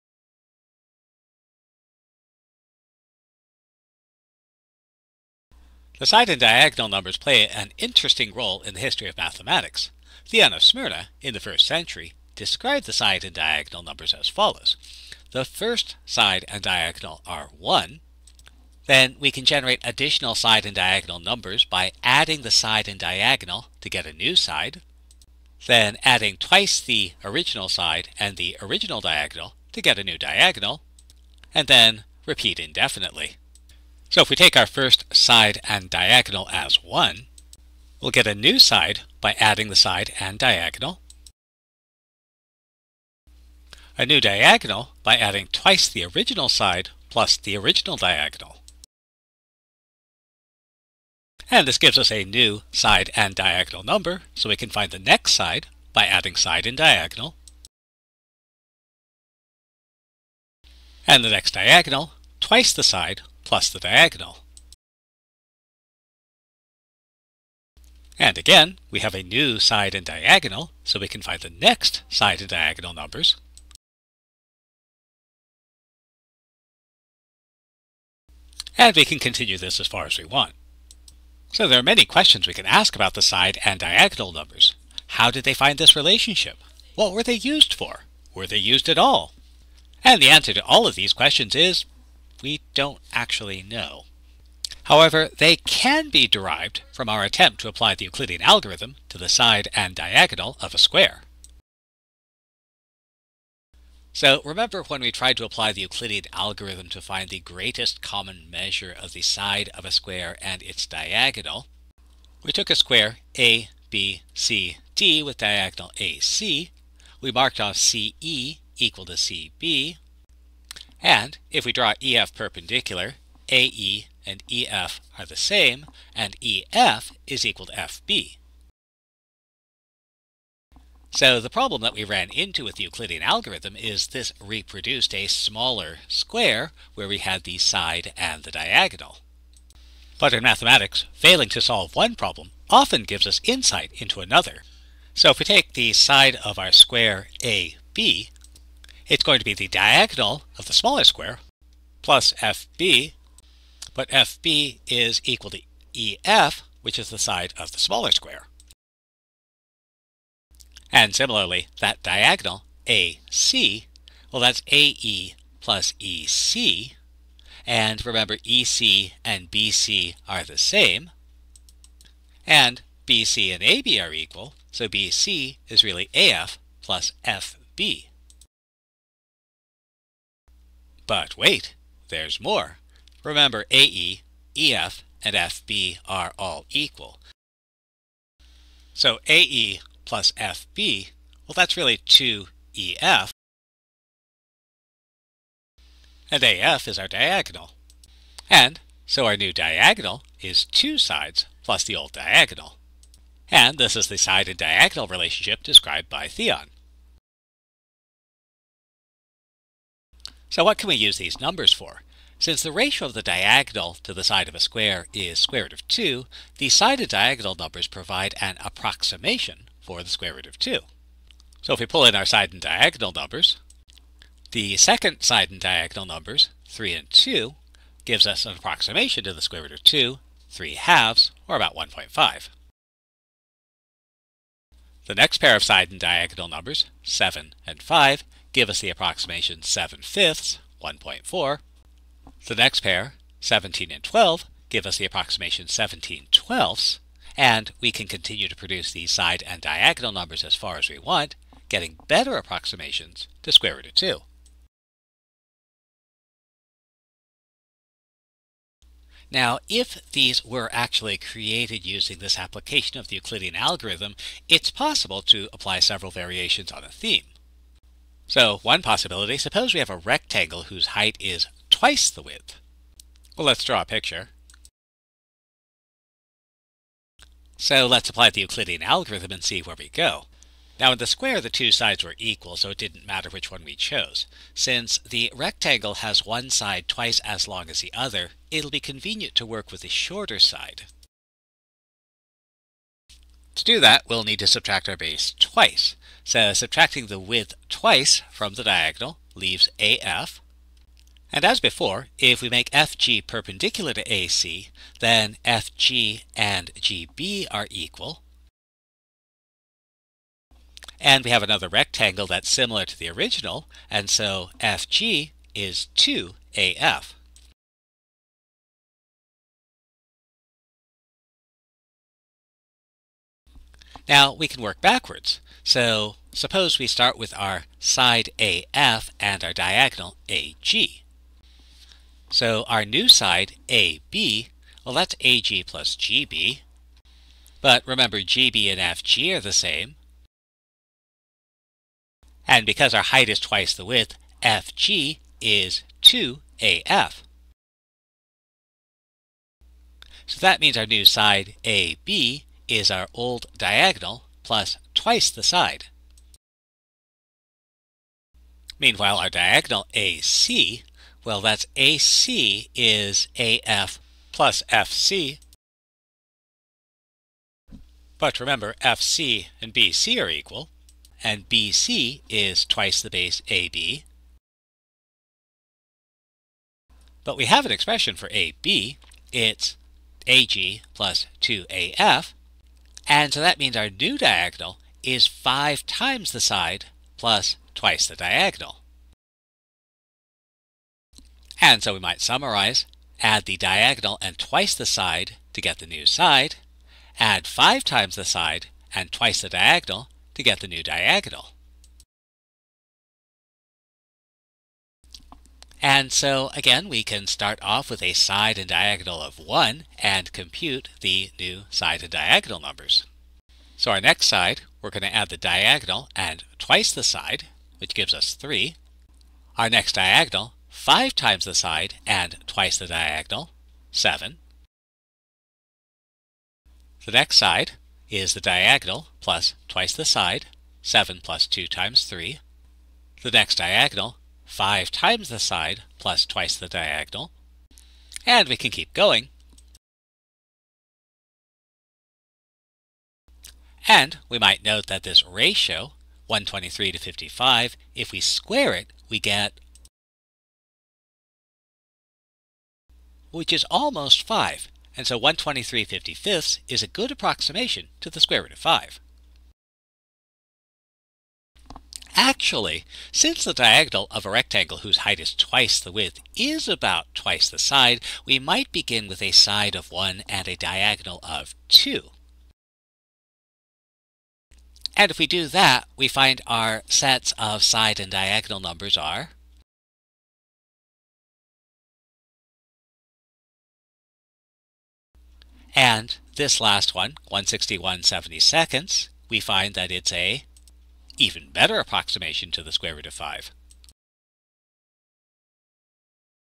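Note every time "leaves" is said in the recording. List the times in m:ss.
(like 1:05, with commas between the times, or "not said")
4:59.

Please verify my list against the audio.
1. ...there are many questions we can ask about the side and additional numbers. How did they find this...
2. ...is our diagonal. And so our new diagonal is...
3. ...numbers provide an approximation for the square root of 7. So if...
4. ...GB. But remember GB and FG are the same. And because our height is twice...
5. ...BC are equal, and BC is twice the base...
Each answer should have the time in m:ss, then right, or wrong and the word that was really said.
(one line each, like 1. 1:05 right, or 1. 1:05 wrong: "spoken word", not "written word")
1. 1:21 wrong: "diagonal", not "additional"
2. 3:16 right
3. 3:37 wrong: "2", not "7"
4. 5:35 right
5. 6:09 right.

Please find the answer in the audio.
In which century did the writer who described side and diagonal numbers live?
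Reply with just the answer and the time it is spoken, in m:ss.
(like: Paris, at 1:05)
first century, at 0:11.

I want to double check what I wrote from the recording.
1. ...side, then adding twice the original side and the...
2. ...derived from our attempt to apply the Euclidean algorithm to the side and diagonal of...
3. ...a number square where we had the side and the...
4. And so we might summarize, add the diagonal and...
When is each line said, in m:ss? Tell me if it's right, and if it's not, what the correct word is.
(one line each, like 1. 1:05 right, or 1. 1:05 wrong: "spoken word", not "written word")
1. 0:24 right
2. 1:36 right
3. 2:15 wrong: "smaller", not "number"
4. 6:31 right.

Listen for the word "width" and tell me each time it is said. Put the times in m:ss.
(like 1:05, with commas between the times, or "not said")
4:32, 4:57, 5:43, 7:45.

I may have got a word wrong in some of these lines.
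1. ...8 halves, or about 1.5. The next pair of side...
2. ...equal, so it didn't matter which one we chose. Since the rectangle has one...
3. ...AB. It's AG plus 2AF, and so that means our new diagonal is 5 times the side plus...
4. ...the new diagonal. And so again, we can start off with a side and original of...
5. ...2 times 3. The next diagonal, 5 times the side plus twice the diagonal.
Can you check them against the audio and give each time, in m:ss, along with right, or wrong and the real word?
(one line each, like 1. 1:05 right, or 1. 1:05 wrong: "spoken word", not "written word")
1. 3:50 wrong: "3", not "8"
2. 4:42 right
3. 6:18 right
4. 6:40 wrong: "diagonal", not "original"
5. 7:11 right.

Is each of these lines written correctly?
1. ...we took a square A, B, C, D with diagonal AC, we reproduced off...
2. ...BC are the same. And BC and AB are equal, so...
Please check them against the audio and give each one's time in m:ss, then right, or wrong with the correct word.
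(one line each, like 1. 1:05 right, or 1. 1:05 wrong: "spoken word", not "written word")
1. 1:52 wrong: "marked", not "reproduced"
2. 2:49 right.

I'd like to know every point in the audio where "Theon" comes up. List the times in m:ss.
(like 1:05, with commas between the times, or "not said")
0:10, 3:26.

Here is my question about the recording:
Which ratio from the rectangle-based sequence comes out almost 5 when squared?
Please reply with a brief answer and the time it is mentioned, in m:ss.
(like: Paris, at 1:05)
123/55, at 7:26.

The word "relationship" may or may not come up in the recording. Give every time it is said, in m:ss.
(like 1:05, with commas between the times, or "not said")
1:25, 3:25.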